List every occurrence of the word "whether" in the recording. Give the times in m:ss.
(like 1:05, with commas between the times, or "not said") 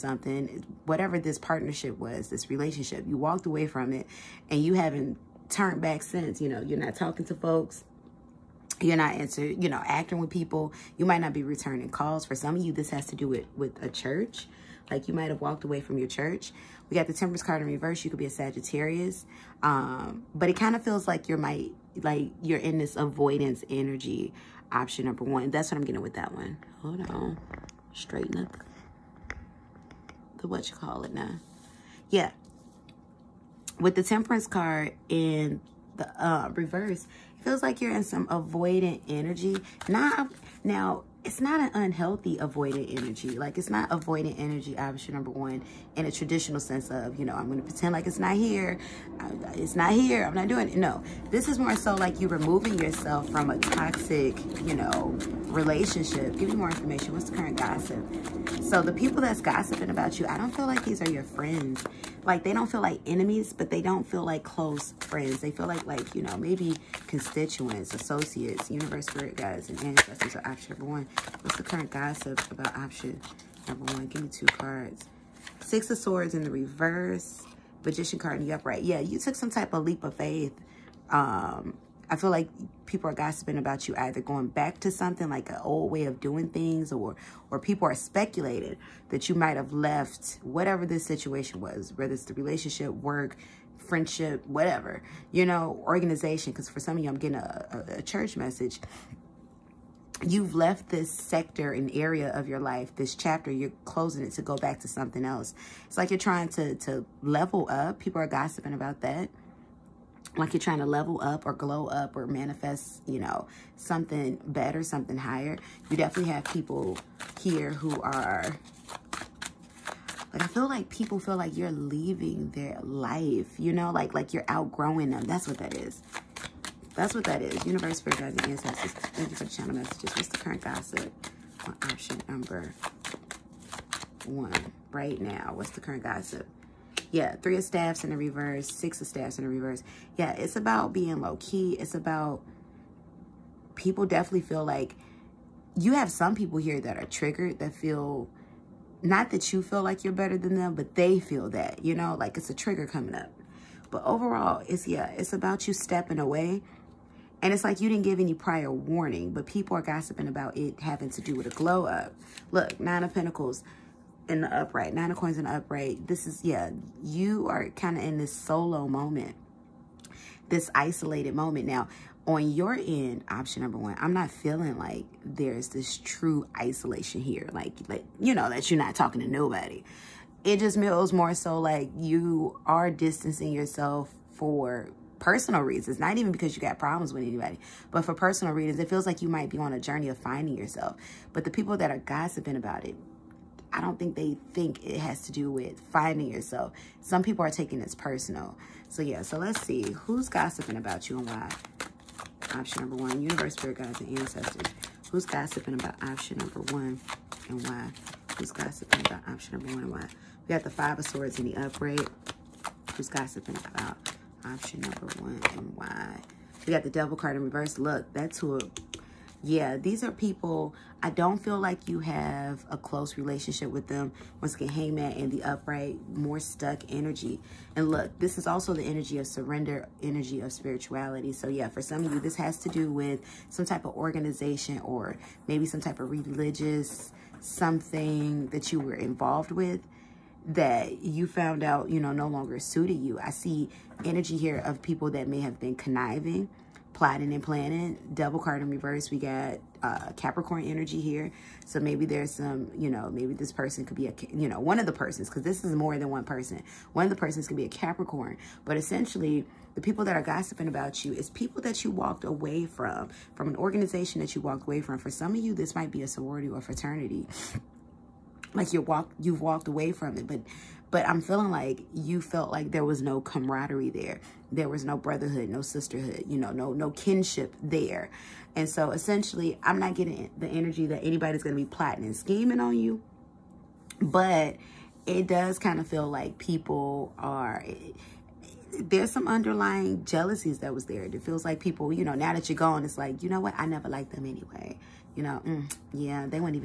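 1:31.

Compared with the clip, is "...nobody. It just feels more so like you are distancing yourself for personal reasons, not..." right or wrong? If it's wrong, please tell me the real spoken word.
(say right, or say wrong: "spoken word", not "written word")
right.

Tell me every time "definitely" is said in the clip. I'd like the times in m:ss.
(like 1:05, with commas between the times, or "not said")
1:55, 2:24.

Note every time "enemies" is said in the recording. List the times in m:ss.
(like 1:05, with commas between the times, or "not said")
1:03.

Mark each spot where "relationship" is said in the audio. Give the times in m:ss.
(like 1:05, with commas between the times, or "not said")
0:02, 0:55, 1:32, 3:43.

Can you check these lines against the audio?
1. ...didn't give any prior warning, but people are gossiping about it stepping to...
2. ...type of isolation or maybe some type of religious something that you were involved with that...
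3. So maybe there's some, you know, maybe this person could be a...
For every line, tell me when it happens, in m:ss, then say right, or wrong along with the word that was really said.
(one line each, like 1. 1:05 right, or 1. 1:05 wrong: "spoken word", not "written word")
1. 2:37 wrong: "having", not "stepping"
2. 3:53 wrong: "organization", not "isolation"
3. 4:11 right.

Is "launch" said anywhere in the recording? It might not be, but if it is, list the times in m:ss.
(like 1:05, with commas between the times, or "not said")
not said.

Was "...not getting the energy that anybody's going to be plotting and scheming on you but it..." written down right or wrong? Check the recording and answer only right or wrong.
right.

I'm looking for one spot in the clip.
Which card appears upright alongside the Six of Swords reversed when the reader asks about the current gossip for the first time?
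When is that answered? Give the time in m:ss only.
1:17.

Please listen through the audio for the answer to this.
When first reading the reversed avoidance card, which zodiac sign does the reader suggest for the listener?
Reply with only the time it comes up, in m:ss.
0:18.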